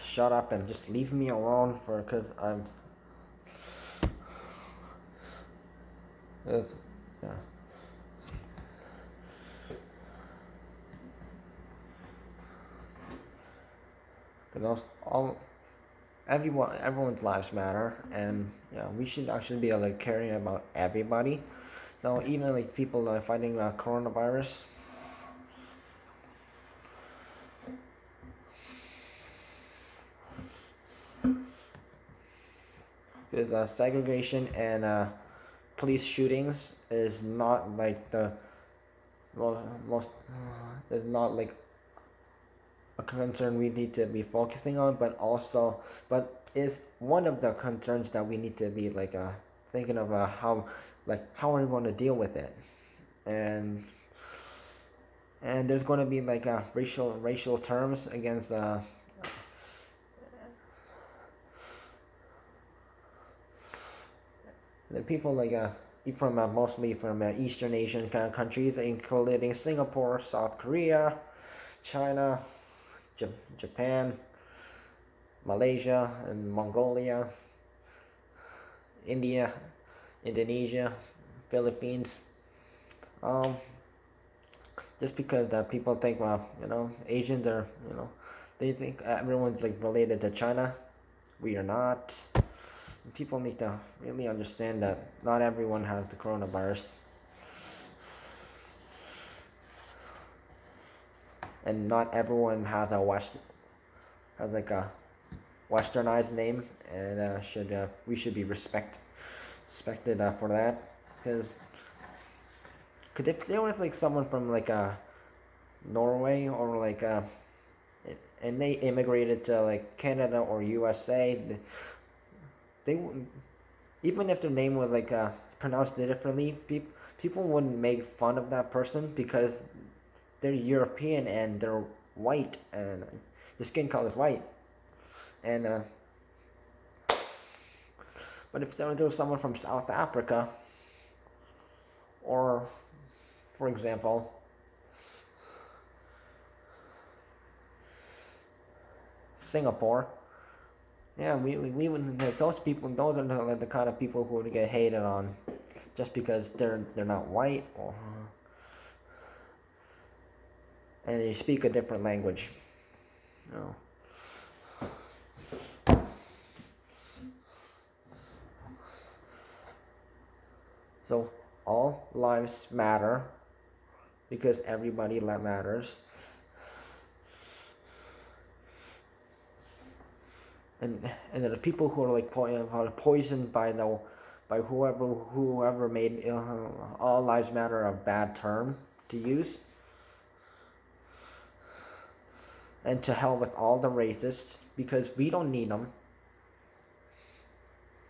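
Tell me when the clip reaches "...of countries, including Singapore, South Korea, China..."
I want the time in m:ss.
1:08.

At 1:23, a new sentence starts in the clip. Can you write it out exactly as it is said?
Um, just because uh, people think, well, you know, Asians are, you know, they think everyone's like related to China.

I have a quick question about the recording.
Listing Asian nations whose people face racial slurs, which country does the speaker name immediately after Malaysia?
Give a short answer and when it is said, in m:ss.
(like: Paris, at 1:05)
Mongolia, at 1:16.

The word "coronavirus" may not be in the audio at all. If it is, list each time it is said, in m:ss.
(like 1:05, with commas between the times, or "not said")
0:23, 1:36.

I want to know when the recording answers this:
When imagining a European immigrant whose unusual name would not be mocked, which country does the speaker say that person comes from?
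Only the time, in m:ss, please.
1:55.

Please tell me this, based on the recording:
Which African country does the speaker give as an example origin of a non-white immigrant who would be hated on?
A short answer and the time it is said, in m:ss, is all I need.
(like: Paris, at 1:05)
South Africa, at 2:19.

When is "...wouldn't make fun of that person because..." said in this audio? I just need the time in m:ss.
2:07.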